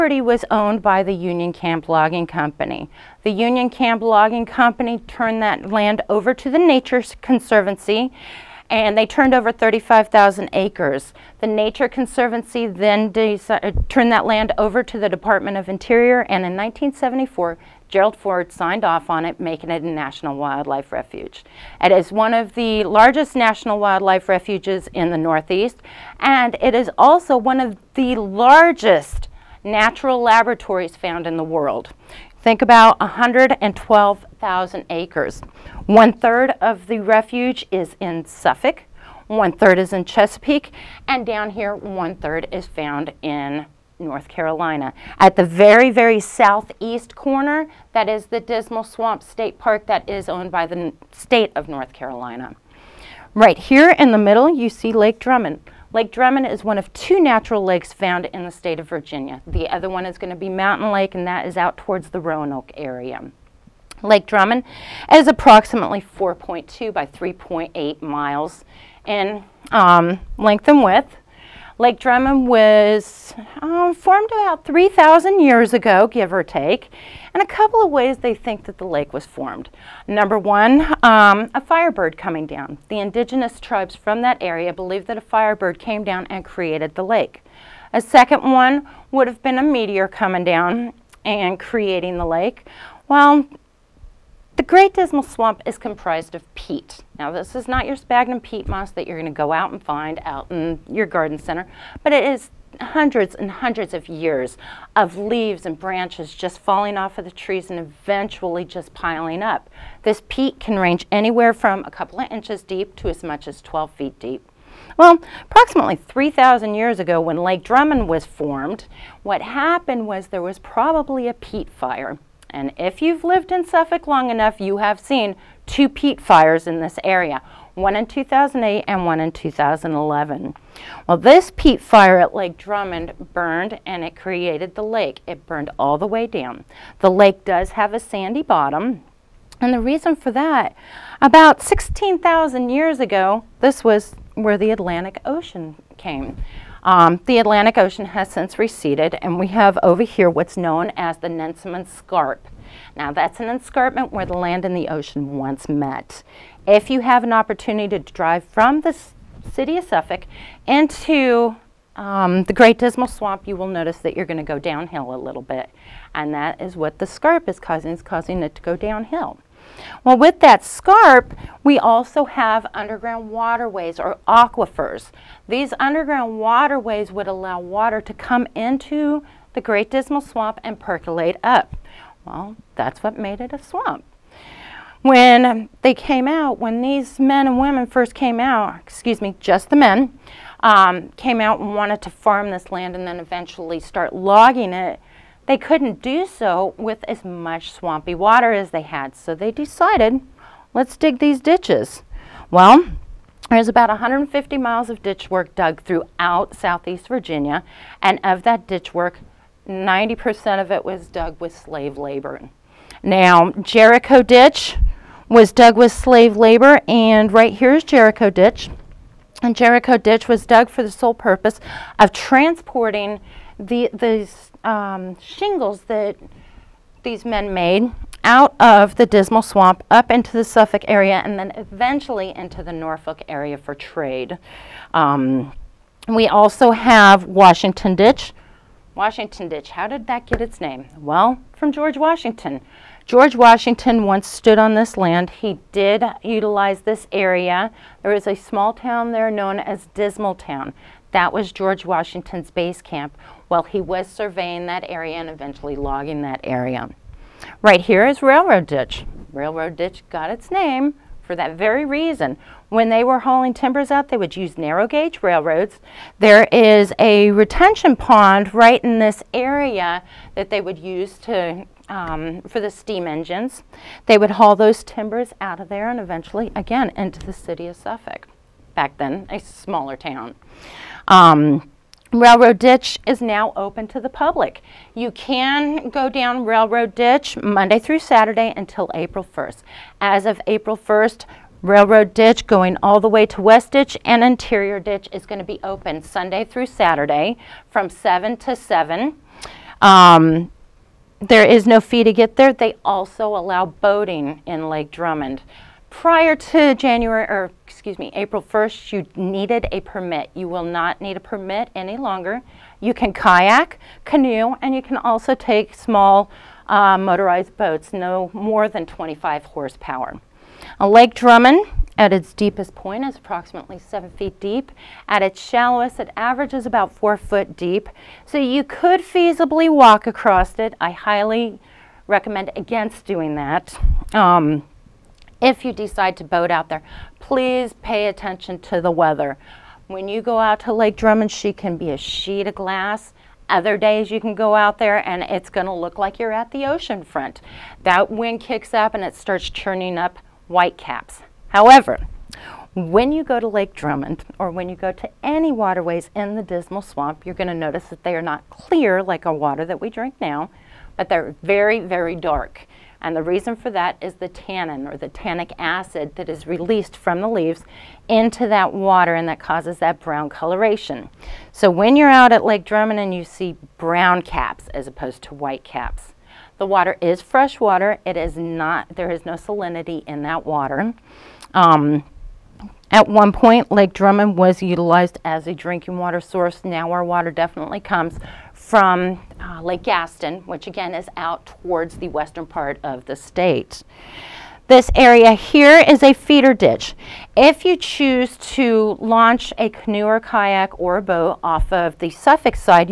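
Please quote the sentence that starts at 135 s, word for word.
It burned all the way down.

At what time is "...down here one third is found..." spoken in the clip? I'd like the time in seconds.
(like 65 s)
41 s.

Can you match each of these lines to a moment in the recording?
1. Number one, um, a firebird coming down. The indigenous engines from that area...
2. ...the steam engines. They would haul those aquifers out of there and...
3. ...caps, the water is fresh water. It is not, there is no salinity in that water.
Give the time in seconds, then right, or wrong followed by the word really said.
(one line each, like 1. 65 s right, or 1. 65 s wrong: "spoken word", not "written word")
1. 80 s wrong: "tribes", not "engines"
2. 272 s wrong: "timbers", not "aquifers"
3. 375 s right.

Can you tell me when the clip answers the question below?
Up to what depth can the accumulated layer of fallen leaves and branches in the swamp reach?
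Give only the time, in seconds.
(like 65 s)
113 s.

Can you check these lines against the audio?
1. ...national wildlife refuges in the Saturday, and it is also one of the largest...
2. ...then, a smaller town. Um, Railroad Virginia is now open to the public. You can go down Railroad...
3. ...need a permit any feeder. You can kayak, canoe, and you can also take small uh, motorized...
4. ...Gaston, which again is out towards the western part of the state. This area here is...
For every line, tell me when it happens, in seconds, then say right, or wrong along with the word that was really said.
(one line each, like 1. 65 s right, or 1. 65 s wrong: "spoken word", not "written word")
1. 23 s wrong: "Northeast", not "Saturday"
2. 278 s wrong: "Ditch", not "Virginia"
3. 311 s wrong: "longer", not "feeder"
4. 389 s right.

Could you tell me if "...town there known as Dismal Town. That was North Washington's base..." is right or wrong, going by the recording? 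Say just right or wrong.
wrong.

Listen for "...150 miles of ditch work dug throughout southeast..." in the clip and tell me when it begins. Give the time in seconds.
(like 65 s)
203 s.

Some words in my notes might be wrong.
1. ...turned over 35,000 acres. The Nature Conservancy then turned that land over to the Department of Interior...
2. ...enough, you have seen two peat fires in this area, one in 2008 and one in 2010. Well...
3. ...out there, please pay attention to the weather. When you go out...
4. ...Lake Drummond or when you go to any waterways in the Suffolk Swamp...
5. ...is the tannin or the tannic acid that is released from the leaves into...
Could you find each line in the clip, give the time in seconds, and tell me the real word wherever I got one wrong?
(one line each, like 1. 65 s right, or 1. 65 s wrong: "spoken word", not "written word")
1. 9 s right
2. 124 s wrong: "2011", not "2010"
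3. 336 s right
4. 353 s wrong: "Dismal", not "Suffolk"
5. 364 s right.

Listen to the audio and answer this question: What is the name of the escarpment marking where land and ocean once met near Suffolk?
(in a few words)
Nansemond Scarp.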